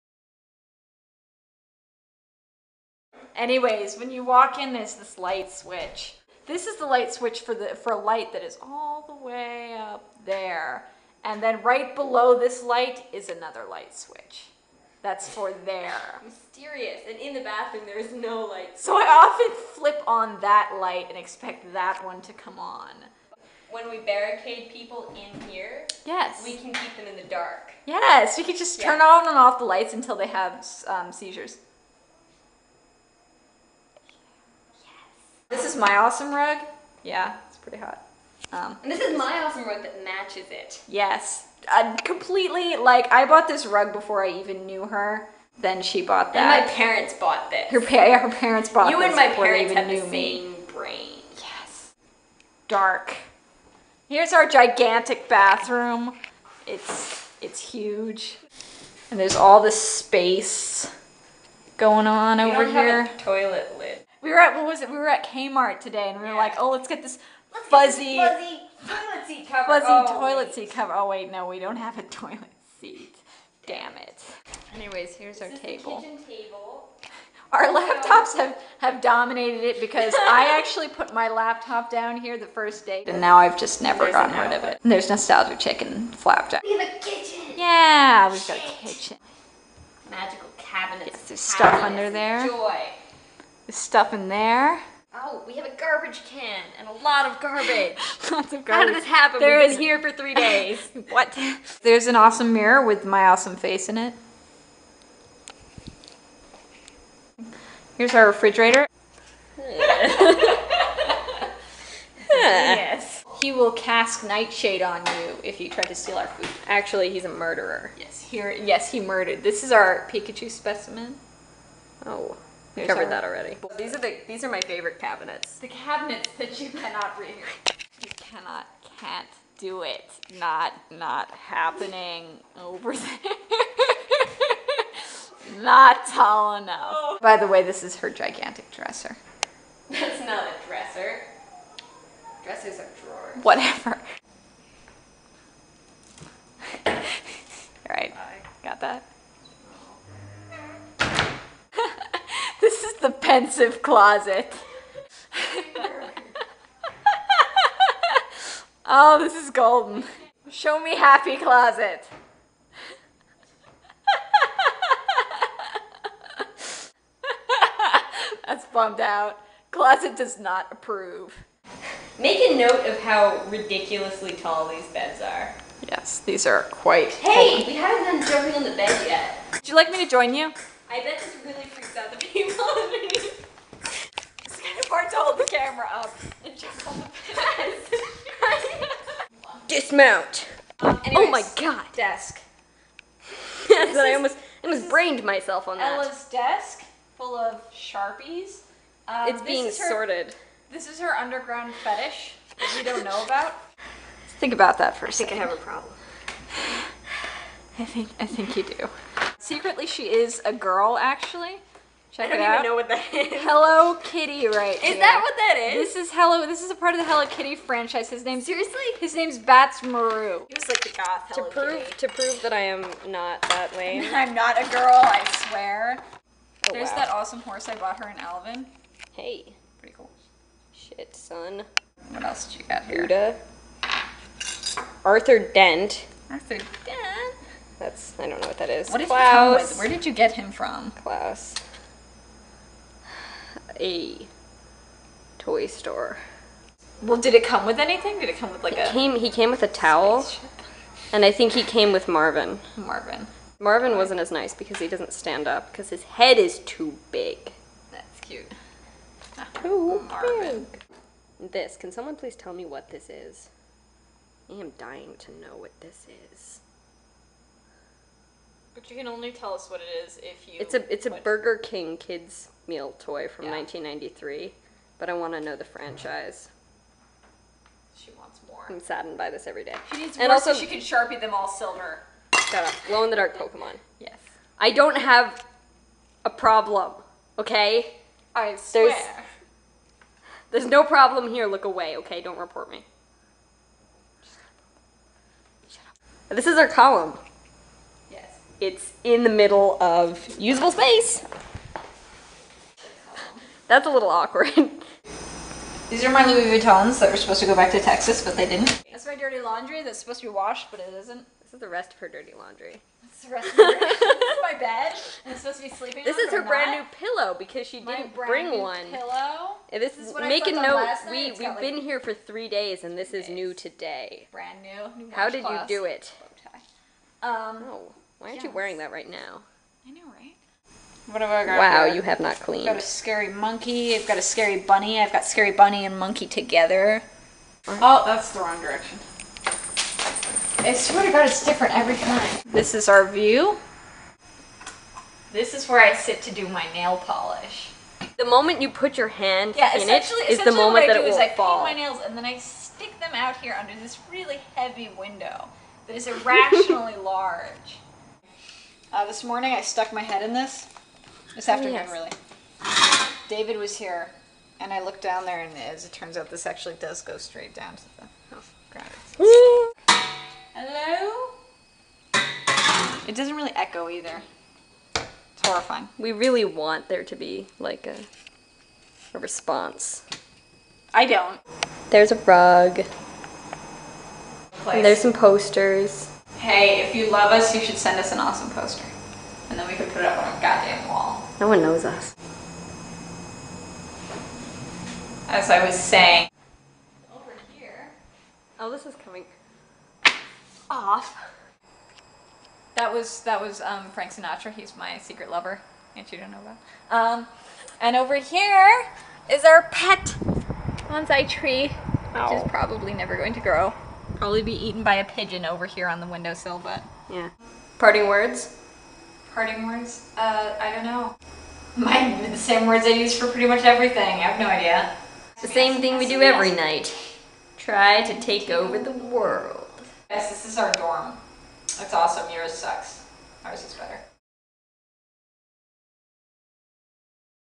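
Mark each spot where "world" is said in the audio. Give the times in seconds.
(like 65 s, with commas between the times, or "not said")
428 s.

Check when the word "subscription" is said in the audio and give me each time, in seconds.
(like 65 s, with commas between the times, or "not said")
not said.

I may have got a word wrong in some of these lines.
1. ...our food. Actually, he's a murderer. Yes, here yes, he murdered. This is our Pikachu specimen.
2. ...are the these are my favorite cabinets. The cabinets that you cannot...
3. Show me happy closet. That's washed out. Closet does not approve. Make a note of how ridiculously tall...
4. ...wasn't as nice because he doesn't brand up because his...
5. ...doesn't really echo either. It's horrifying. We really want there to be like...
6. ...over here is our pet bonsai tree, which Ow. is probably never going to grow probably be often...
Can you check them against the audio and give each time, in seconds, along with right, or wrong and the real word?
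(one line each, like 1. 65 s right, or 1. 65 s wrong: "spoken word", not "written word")
1. 116 s right
2. 123 s right
3. 160 s wrong: "bummed", not "washed"
4. 253 s wrong: "stand", not "brand"
5. 373 s right
6. 407 s wrong: "eaten", not "often".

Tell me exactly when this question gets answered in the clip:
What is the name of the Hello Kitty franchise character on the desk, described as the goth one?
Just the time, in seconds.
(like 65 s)
219 s.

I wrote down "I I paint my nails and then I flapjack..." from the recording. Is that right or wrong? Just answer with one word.
wrong.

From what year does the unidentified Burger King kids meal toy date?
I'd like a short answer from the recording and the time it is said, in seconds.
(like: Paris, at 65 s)
1993, at 273 s.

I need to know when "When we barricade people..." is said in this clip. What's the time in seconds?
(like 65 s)
23 s.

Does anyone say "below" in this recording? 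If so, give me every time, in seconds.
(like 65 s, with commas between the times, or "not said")
11 s.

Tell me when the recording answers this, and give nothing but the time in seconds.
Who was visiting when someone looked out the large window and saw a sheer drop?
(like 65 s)
363 s.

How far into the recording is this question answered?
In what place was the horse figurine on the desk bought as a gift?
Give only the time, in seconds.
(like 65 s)
228 s.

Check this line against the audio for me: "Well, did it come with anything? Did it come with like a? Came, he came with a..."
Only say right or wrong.
right.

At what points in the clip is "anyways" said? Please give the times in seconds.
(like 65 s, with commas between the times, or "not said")
3 s, 74 s, 191 s.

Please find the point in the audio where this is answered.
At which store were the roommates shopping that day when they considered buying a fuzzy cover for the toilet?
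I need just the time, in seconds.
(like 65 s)
65 s.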